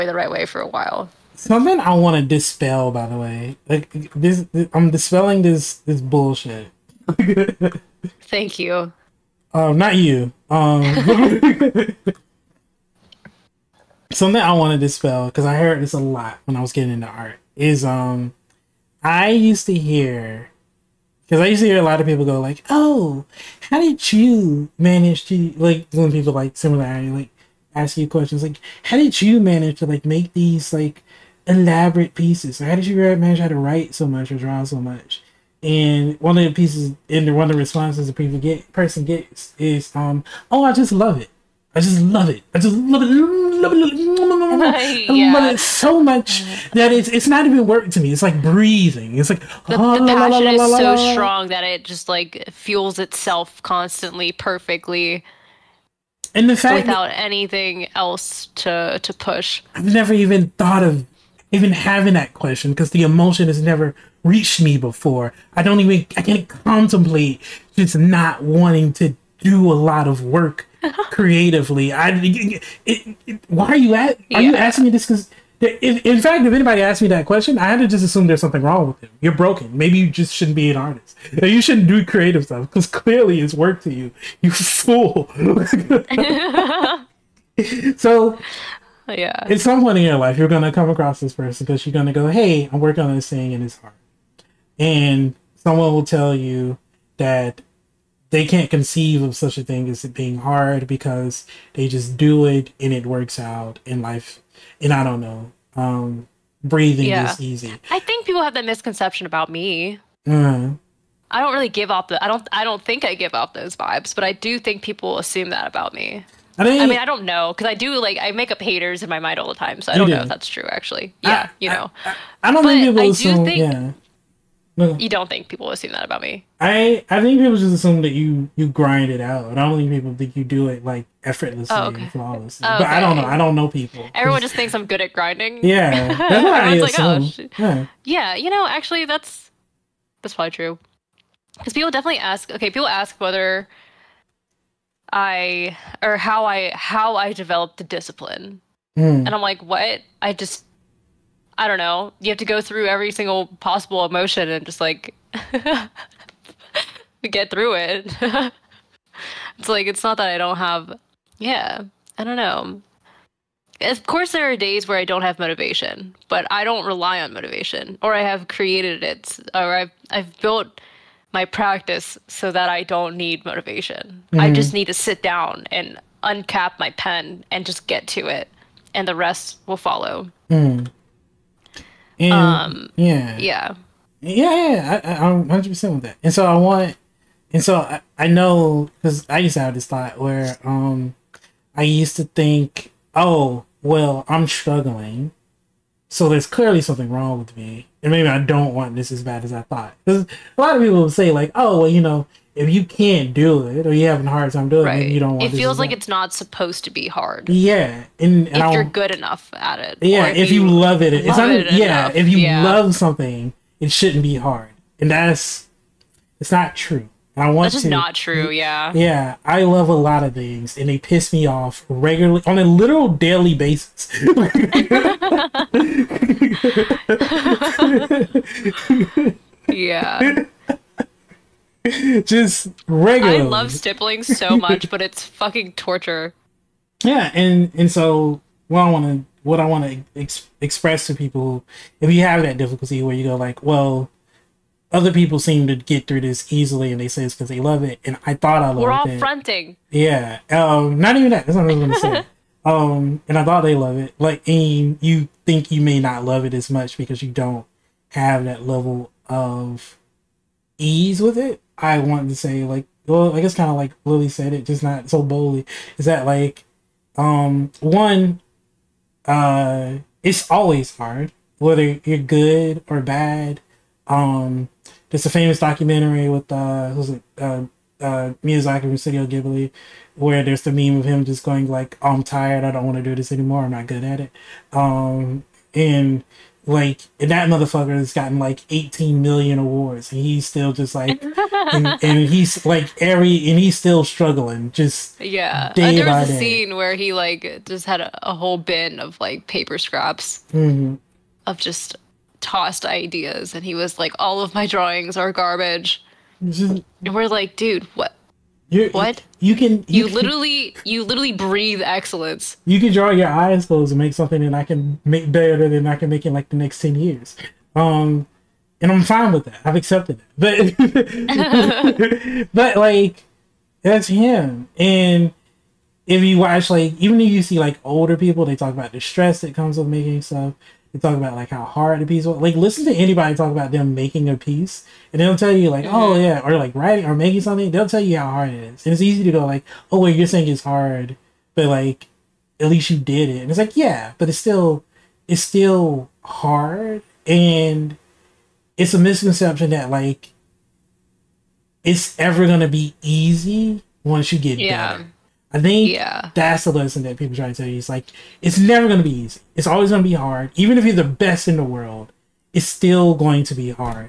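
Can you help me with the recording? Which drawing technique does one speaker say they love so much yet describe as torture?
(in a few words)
stippling.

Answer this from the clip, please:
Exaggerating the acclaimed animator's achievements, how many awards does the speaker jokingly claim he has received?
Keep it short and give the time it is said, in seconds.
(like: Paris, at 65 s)
18 million, at 288 s.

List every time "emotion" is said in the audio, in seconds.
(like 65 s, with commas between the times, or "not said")
63 s, 154 s.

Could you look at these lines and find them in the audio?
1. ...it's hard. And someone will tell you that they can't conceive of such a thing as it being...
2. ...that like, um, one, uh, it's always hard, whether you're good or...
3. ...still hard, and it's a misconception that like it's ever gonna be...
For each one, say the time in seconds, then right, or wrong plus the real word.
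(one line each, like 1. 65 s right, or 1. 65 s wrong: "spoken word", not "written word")
1. 93 s right
2. 266 s right
3. 345 s right.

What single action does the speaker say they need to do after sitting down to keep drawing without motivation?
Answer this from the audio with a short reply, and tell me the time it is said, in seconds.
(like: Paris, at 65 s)
uncap my pen, at 176 s.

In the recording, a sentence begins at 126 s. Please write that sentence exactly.
I I think people just assume that you you grind it out.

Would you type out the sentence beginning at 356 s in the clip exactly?
that's the lesson that people try to tell you.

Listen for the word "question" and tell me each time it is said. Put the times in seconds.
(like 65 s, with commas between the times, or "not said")
28 s, 62 s, 77 s.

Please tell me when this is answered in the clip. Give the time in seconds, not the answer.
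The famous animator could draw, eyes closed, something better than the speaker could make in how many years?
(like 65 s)
316 s.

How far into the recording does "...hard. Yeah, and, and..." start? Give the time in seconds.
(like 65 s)
207 s.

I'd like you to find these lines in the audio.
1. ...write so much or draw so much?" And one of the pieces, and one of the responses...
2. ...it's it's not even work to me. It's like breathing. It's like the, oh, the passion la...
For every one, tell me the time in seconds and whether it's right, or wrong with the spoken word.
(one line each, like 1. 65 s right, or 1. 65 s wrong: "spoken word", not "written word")
1. 33 s right
2. 46 s right.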